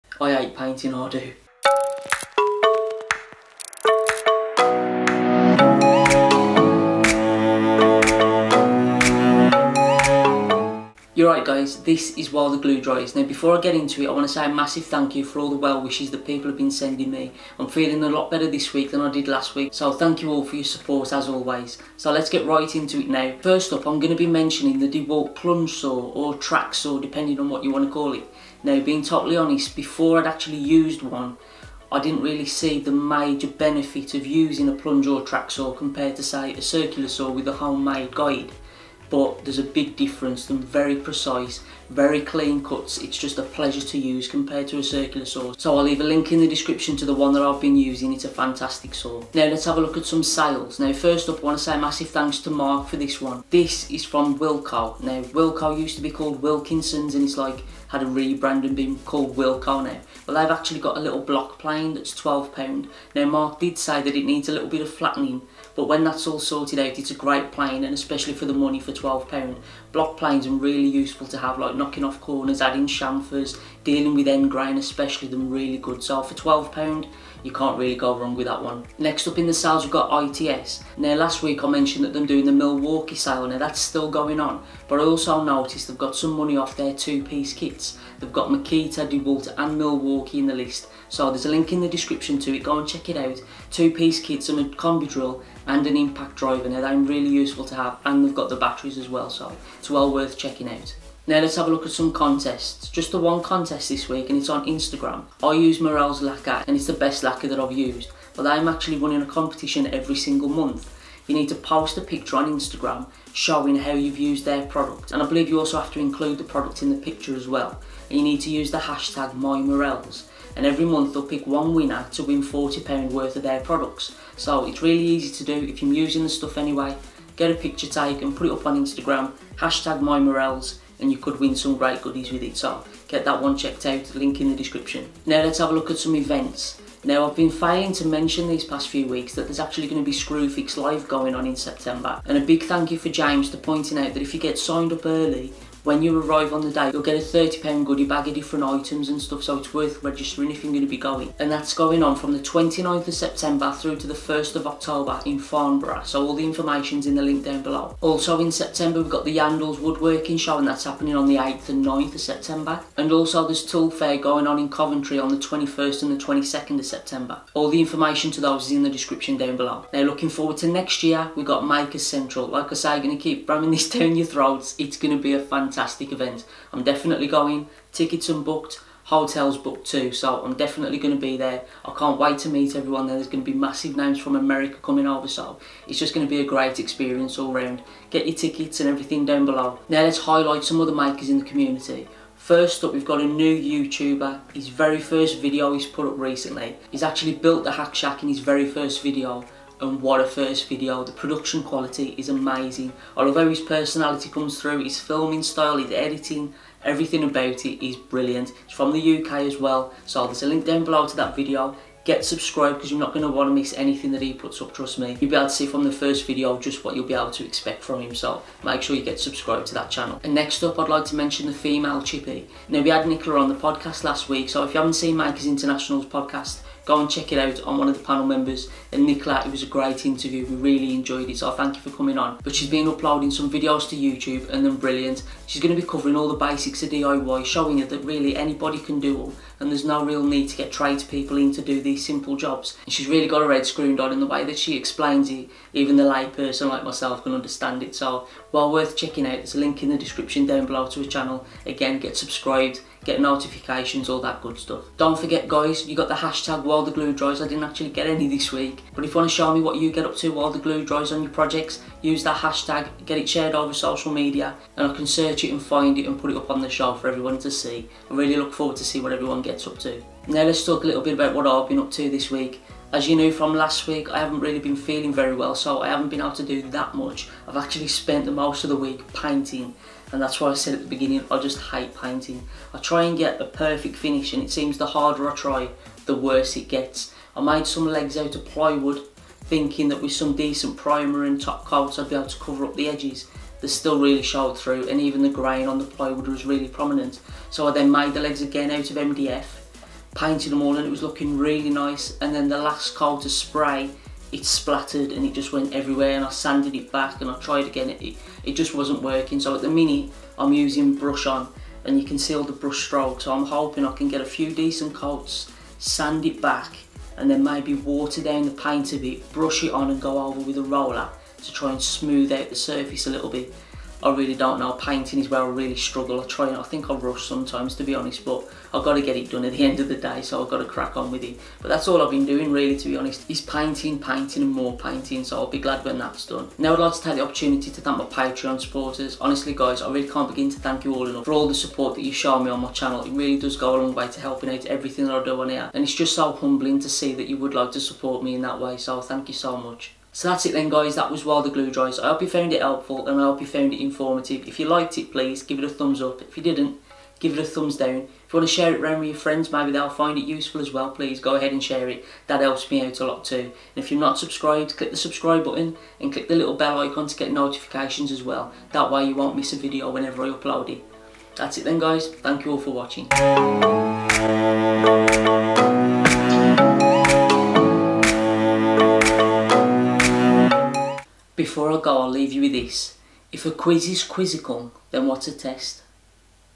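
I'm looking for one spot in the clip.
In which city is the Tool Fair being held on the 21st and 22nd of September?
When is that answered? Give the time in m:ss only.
2:44.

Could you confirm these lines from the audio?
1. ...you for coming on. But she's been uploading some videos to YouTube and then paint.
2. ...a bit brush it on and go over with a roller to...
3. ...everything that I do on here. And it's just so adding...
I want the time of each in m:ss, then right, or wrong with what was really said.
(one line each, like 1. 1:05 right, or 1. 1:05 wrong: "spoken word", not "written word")
1. 3:51 wrong: "brilliant", not "paint"
2. 5:18 right
3. 5:44 wrong: "humbling", not "adding".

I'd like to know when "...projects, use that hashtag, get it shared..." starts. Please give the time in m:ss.
4:21.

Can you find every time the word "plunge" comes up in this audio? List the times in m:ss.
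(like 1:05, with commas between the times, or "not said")
0:25, 0:34.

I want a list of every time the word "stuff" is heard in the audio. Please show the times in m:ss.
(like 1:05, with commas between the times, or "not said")
2:06, 2:29, 4:14.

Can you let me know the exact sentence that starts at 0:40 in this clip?
They're very precise, very clean cuts.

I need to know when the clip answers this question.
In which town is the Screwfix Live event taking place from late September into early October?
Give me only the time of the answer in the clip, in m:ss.
2:35.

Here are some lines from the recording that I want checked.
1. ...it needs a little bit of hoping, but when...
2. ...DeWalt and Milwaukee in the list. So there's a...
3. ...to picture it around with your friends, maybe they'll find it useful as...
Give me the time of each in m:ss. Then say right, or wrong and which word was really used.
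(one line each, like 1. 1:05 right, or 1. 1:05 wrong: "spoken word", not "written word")
1. 1:04 wrong: "flattening", not "hoping"
2. 1:29 right
3. 5:58 wrong: "share", not "picture".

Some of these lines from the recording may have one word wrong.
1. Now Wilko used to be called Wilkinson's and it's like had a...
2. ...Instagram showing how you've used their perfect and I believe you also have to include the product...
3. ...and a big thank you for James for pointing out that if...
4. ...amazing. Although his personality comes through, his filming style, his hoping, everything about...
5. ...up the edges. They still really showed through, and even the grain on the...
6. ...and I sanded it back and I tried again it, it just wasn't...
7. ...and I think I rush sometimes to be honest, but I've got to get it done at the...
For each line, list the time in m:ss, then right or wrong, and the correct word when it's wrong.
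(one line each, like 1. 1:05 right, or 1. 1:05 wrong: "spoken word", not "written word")
1. 0:55 right
2. 1:52 wrong: "product", not "perfect"
3. 2:22 right
4. 3:22 wrong: "editing", not "hoping"
5. 4:52 right
6. 5:06 right
7. 5:26 right.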